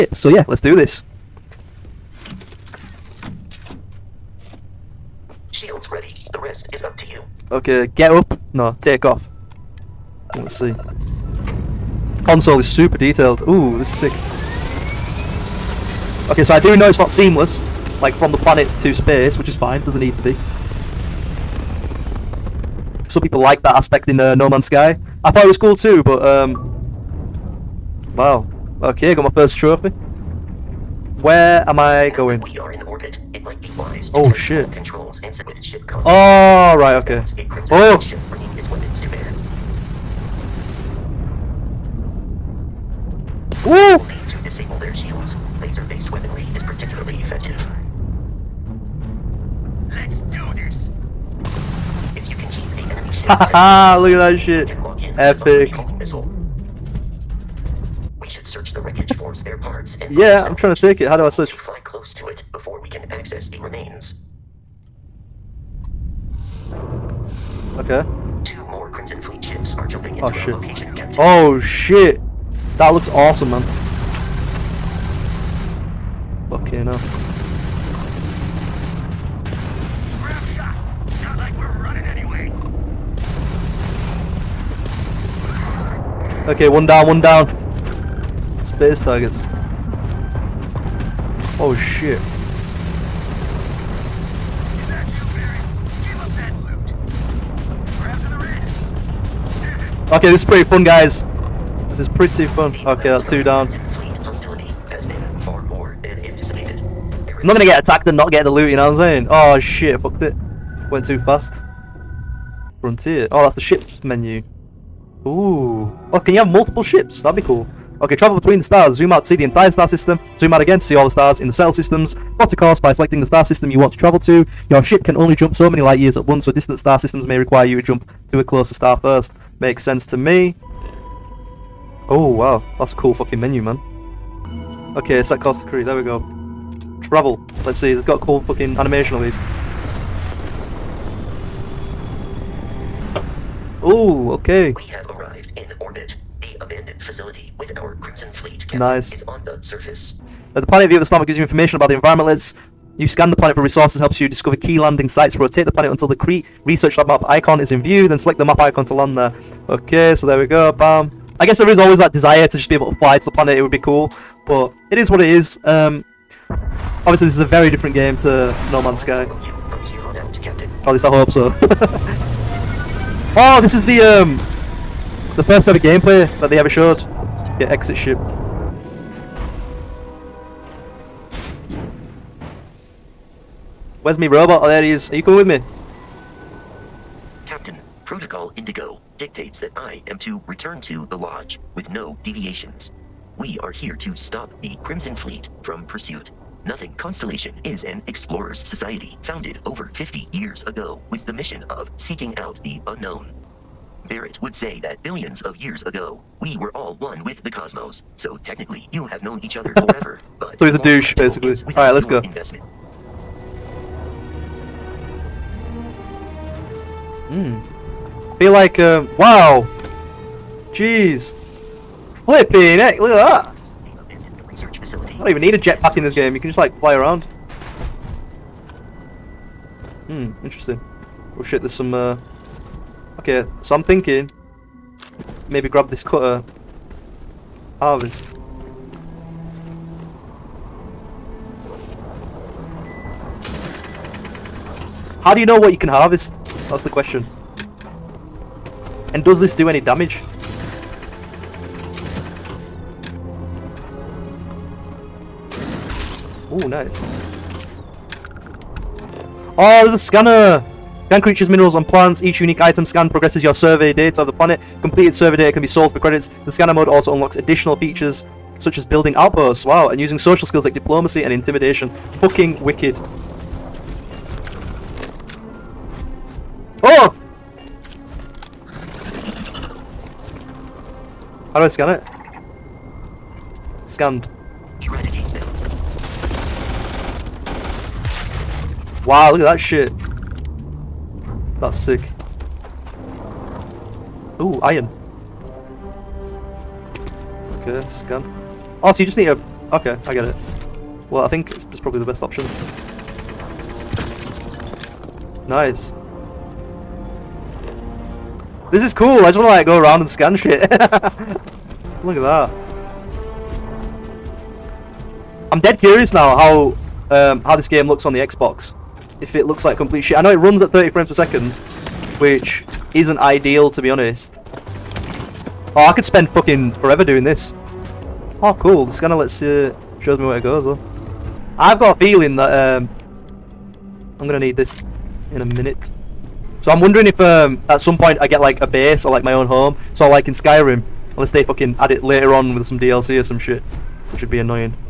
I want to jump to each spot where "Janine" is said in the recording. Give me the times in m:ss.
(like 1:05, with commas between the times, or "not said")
not said.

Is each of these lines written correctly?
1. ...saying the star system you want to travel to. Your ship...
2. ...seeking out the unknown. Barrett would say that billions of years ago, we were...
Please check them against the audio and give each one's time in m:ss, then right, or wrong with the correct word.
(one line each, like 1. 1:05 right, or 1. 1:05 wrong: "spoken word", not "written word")
1. 2:02 wrong: "selecting", not "saying"
2. 3:21 right.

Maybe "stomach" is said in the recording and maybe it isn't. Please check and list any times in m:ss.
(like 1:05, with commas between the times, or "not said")
2:31.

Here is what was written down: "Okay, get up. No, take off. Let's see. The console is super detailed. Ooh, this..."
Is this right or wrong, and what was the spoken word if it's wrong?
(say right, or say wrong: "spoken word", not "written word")
right.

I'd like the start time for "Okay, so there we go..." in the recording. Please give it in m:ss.
2:39.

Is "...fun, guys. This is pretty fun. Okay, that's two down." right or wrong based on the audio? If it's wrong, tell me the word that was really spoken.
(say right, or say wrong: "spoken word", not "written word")
right.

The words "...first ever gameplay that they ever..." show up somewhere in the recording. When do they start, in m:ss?
2:55.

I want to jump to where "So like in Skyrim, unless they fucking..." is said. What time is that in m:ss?
5:39.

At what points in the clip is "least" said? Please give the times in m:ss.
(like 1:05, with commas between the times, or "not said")
2:19, 2:50.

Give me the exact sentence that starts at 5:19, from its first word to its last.
If it looks like complete shit.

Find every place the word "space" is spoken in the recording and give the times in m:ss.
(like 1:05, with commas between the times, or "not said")
0:18, 1:28.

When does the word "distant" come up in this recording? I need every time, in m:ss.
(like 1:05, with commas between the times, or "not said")
2:06.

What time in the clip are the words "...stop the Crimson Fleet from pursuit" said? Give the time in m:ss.
3:14.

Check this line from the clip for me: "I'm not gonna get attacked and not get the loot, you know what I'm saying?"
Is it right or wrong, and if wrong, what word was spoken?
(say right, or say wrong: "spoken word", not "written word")
right.